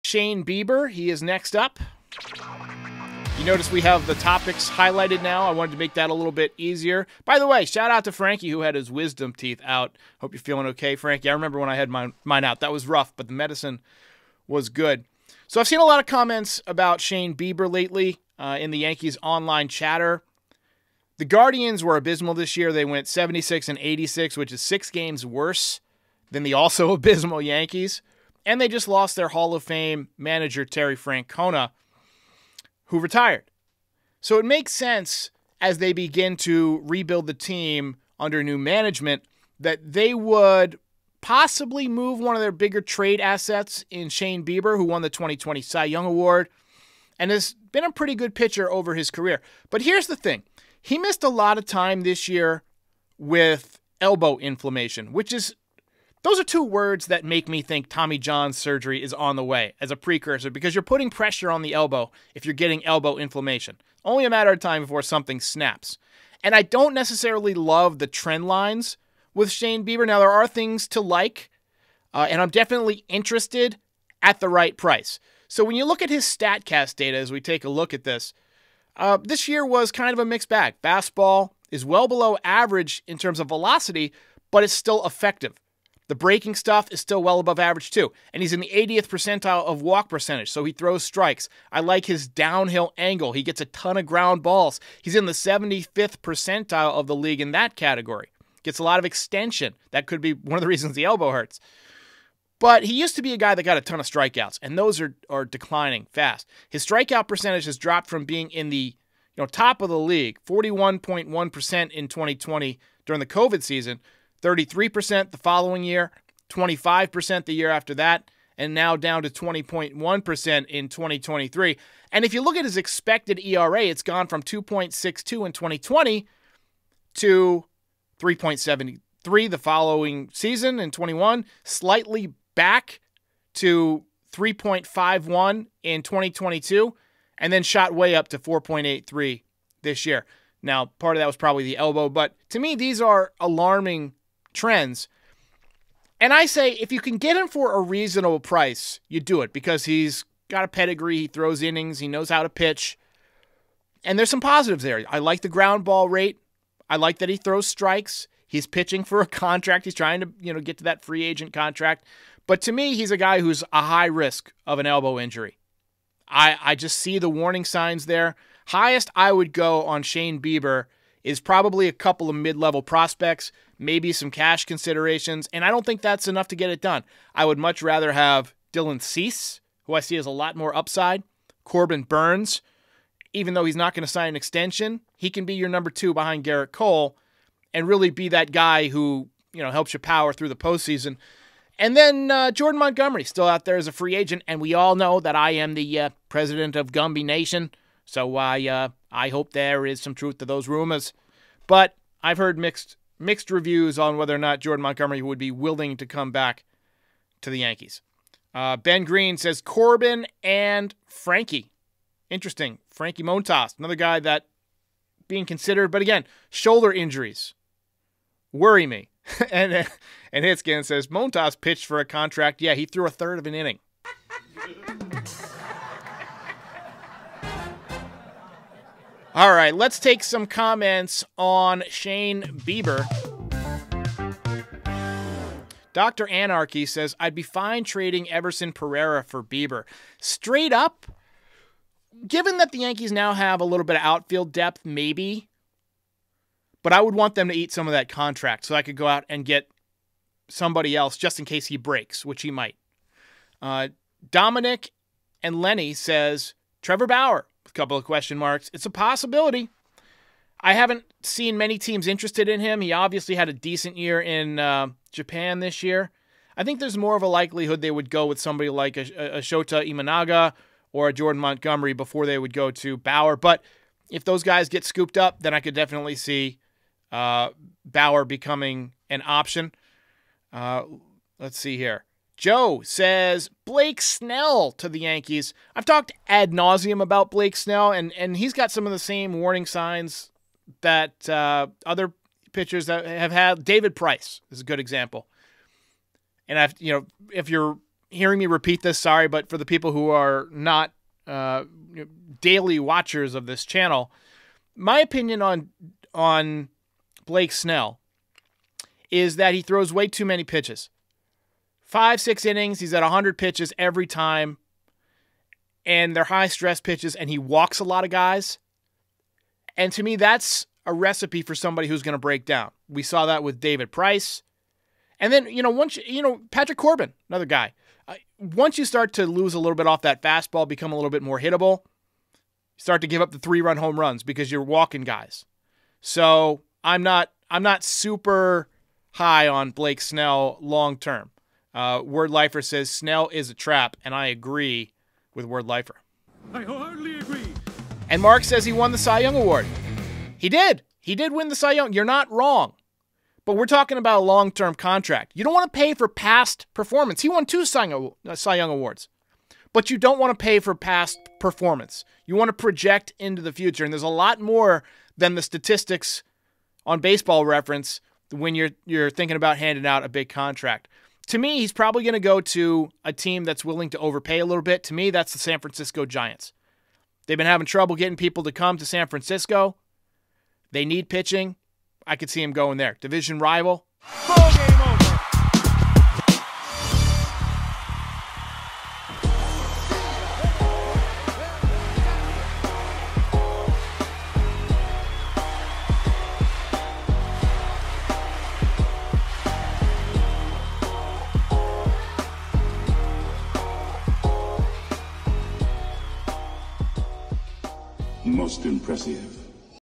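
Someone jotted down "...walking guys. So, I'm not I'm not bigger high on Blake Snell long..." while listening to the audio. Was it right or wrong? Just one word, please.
wrong.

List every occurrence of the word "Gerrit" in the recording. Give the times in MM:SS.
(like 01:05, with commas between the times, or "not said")
03:06.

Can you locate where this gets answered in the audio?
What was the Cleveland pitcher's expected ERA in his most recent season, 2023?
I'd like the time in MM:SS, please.
02:18.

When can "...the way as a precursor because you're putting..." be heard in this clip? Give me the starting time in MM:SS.
00:59.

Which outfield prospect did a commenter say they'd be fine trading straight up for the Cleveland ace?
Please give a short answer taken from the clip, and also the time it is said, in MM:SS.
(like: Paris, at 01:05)
Everson Pereira, at 03:58.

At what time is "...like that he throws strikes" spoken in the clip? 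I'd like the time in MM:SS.
02:36.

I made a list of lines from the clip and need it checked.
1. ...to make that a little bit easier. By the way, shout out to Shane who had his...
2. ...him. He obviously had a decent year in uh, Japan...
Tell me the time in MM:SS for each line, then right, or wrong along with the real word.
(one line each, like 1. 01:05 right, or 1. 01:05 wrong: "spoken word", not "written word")
1. 00:05 wrong: "Frankie", not "Shane"
2. 04:22 right.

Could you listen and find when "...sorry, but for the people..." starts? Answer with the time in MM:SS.
04:58.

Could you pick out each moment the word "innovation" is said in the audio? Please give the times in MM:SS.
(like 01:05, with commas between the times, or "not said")
not said.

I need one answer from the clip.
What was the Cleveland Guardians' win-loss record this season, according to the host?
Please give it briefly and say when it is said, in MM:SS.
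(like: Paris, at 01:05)
76-86, at 00:23.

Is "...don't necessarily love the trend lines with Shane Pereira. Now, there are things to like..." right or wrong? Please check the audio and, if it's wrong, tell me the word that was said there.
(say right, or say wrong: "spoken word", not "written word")
wrong: "Bieber", not "Pereira".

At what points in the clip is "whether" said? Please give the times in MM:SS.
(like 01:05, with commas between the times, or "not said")
03:24.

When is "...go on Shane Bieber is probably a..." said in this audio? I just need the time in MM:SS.
02:49.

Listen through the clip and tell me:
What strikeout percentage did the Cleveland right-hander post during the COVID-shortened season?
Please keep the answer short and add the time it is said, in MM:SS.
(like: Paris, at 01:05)
41.1%, at 01:50.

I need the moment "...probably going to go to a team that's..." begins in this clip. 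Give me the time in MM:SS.
06:11.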